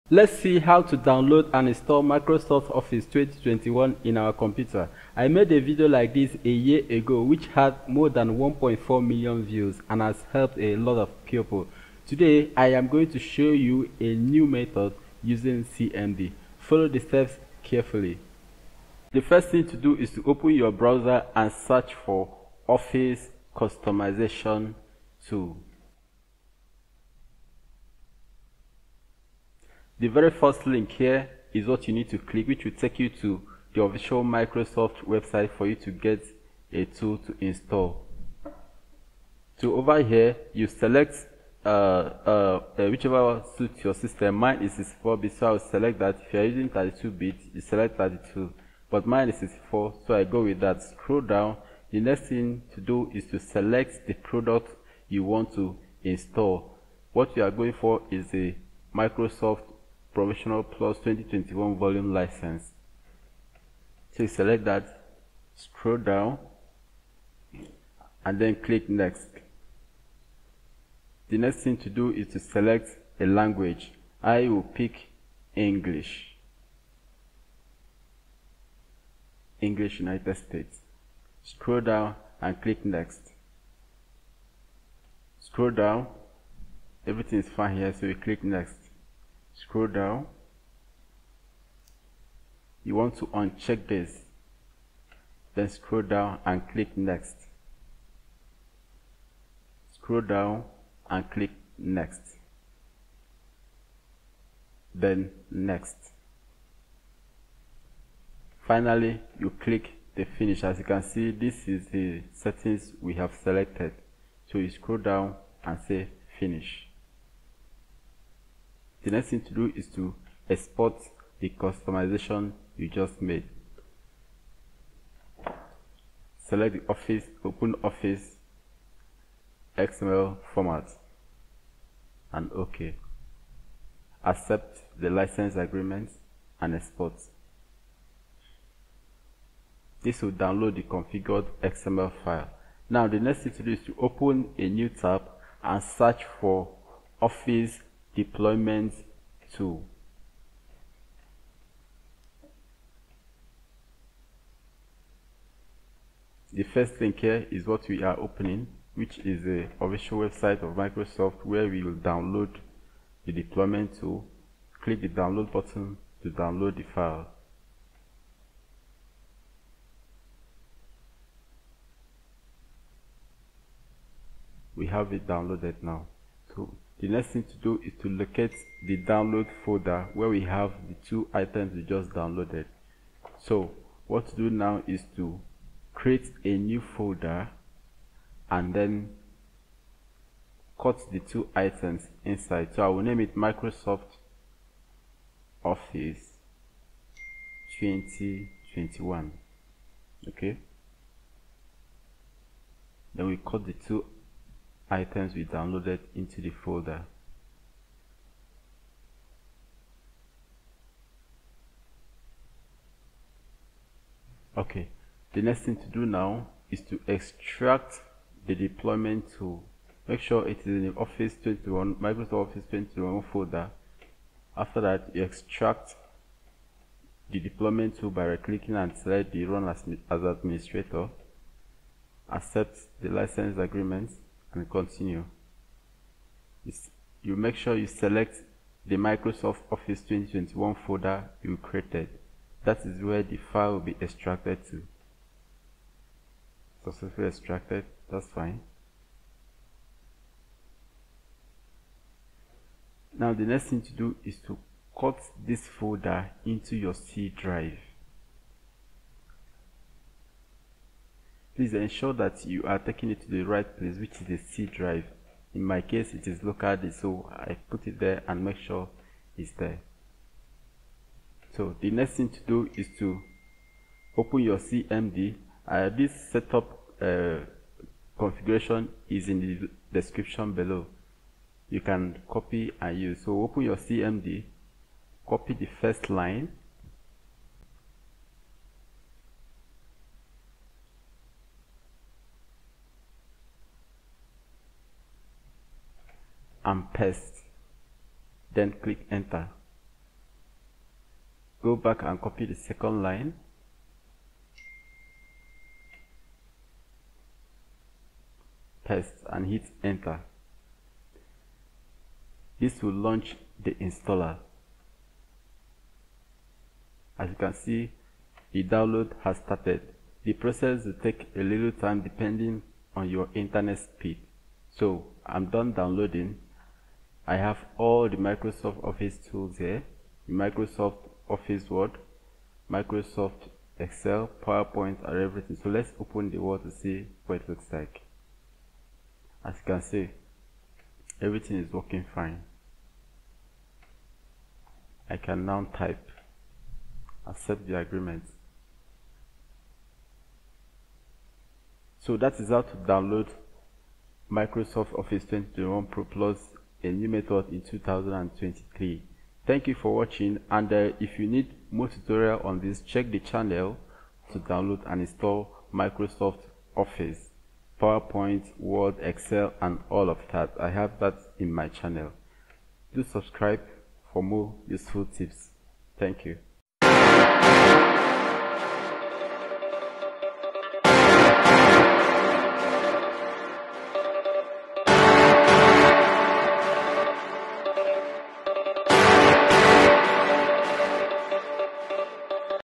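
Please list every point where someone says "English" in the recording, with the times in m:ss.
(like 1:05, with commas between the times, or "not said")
1:15, 1:19.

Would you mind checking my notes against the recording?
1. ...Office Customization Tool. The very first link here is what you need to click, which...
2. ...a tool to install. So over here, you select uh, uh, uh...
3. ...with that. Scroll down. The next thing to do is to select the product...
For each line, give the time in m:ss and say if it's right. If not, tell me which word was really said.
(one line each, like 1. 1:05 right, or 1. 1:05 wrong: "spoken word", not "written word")
1. 0:22 right
2. 0:36 right
3. 0:50 right.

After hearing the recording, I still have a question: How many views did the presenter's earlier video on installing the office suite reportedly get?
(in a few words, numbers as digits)
1.4 million.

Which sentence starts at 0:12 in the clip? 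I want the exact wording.
Today I am going to show you a new method using CMD.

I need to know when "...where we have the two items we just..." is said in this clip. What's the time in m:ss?
3:00.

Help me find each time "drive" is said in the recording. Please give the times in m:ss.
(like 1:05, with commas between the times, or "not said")
4:17, 4:24.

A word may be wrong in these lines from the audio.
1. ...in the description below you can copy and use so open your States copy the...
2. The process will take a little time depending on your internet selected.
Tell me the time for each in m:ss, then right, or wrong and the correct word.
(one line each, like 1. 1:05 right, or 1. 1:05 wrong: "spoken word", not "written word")
1. 4:39 wrong: "CMD", not "States"
2. 5:20 wrong: "speed", not "selected".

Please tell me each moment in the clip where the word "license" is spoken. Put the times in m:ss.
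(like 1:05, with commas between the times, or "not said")
1:02, 2:15, 3:53.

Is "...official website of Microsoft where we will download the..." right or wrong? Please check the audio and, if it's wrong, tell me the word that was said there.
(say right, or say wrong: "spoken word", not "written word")
right.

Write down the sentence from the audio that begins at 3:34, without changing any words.
Okay, the next thing to do now is to extract the deployment tool.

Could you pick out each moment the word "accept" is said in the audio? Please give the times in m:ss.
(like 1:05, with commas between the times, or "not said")
2:14, 3:52, 5:47.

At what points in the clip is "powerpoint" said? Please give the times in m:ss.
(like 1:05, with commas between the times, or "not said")
5:34, 6:07.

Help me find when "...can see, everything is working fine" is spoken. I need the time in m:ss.
5:39.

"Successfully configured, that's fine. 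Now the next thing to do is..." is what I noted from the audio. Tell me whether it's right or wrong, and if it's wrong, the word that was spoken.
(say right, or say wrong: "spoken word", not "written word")
wrong: "extracted", not "configured".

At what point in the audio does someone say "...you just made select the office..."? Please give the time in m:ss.
2:02.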